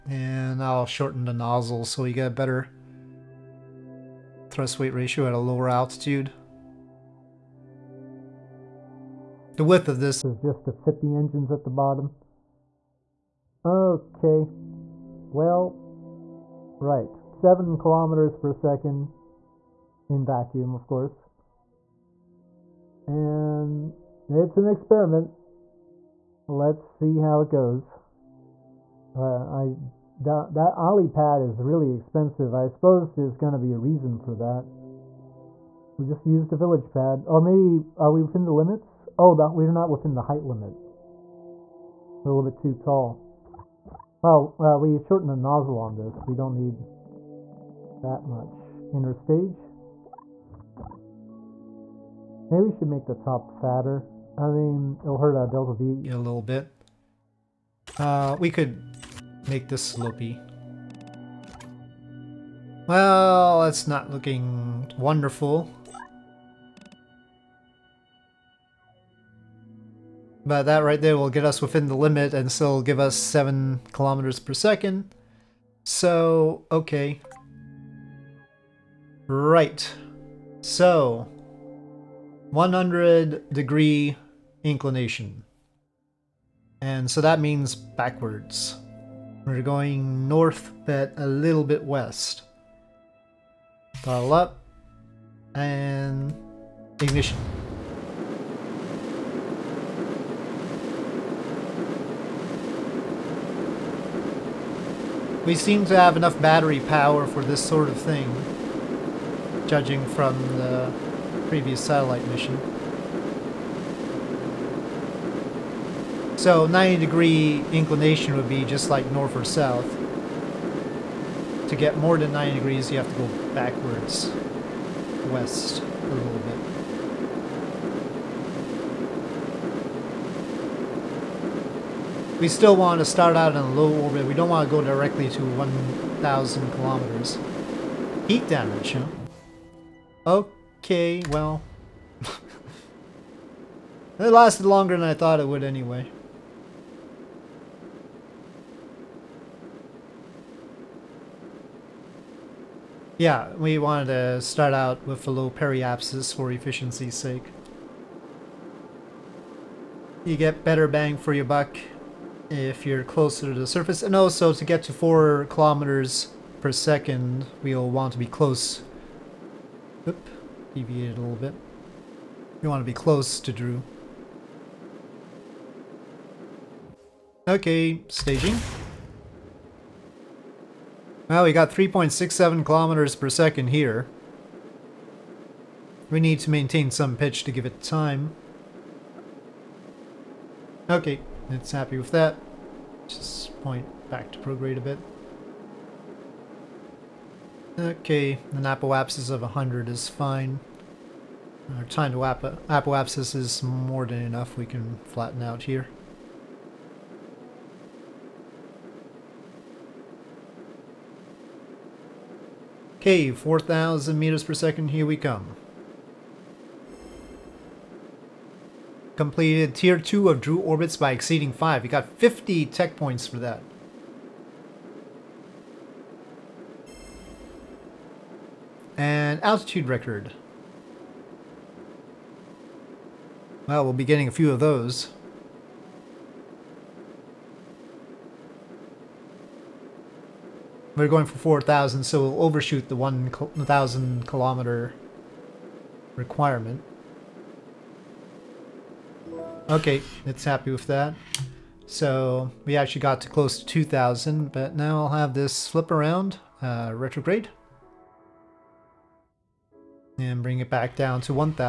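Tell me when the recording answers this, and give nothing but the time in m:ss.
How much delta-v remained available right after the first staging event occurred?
3:01.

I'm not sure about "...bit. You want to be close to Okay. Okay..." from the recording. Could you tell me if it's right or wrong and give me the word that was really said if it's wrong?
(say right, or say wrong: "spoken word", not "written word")
wrong: "Droo", not "Okay".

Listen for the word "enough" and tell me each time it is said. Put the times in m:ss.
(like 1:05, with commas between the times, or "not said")
1:46, 3:24.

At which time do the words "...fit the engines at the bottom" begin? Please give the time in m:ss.
0:10.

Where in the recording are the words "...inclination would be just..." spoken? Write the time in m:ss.
1:57.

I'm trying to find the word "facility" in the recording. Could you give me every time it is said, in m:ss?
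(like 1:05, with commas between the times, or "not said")
not said.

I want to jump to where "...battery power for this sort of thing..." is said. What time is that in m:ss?
1:46.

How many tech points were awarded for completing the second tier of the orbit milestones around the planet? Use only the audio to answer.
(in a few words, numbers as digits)
50.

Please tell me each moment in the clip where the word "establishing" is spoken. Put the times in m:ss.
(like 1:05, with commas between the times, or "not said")
not said.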